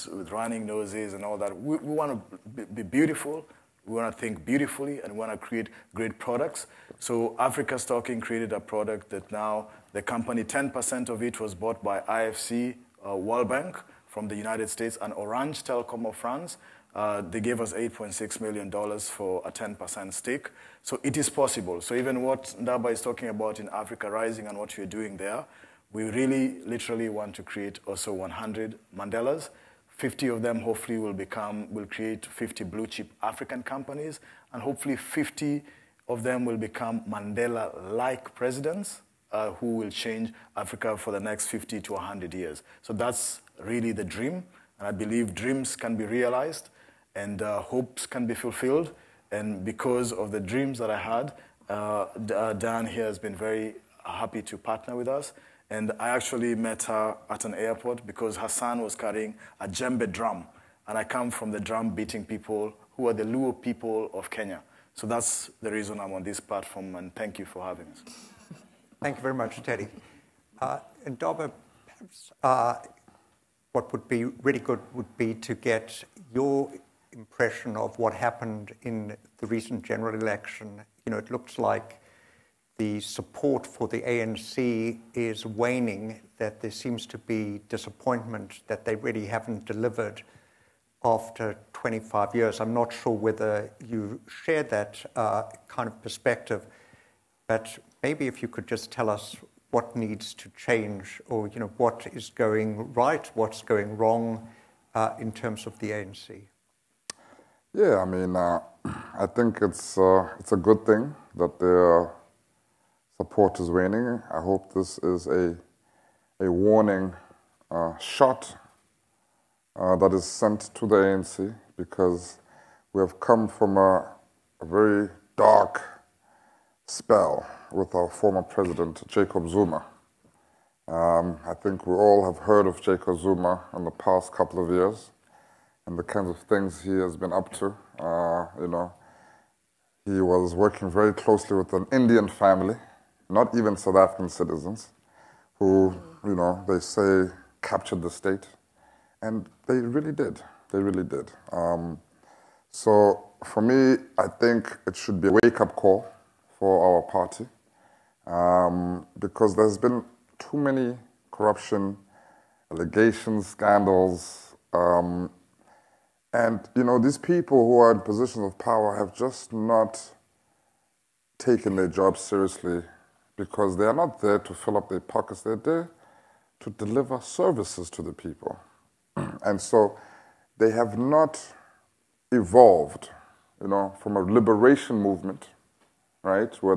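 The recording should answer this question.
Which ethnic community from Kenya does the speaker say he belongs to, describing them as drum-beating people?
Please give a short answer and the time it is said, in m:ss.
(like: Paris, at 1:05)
Luo, at 1:03.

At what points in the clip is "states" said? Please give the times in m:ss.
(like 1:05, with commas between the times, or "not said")
0:14, 2:28.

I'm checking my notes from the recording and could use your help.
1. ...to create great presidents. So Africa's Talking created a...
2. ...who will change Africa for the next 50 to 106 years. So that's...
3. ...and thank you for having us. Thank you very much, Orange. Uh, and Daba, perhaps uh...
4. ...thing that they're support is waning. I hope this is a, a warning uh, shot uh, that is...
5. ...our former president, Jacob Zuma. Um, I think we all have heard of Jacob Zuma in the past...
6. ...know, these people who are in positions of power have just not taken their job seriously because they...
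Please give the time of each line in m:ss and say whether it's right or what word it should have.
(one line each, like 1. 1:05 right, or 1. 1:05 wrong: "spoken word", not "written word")
1. 0:05 wrong: "products", not "presidents"
2. 0:39 wrong: "100", not "106"
3. 1:06 wrong: "Teddy", not "Orange"
4. 1:50 right
5. 2:07 right
6. 2:46 right.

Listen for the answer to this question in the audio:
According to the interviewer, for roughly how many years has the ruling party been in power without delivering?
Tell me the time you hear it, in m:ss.
1:31.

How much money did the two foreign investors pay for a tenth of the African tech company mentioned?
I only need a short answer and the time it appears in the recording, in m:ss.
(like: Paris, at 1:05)
$8.6 million, at 0:17.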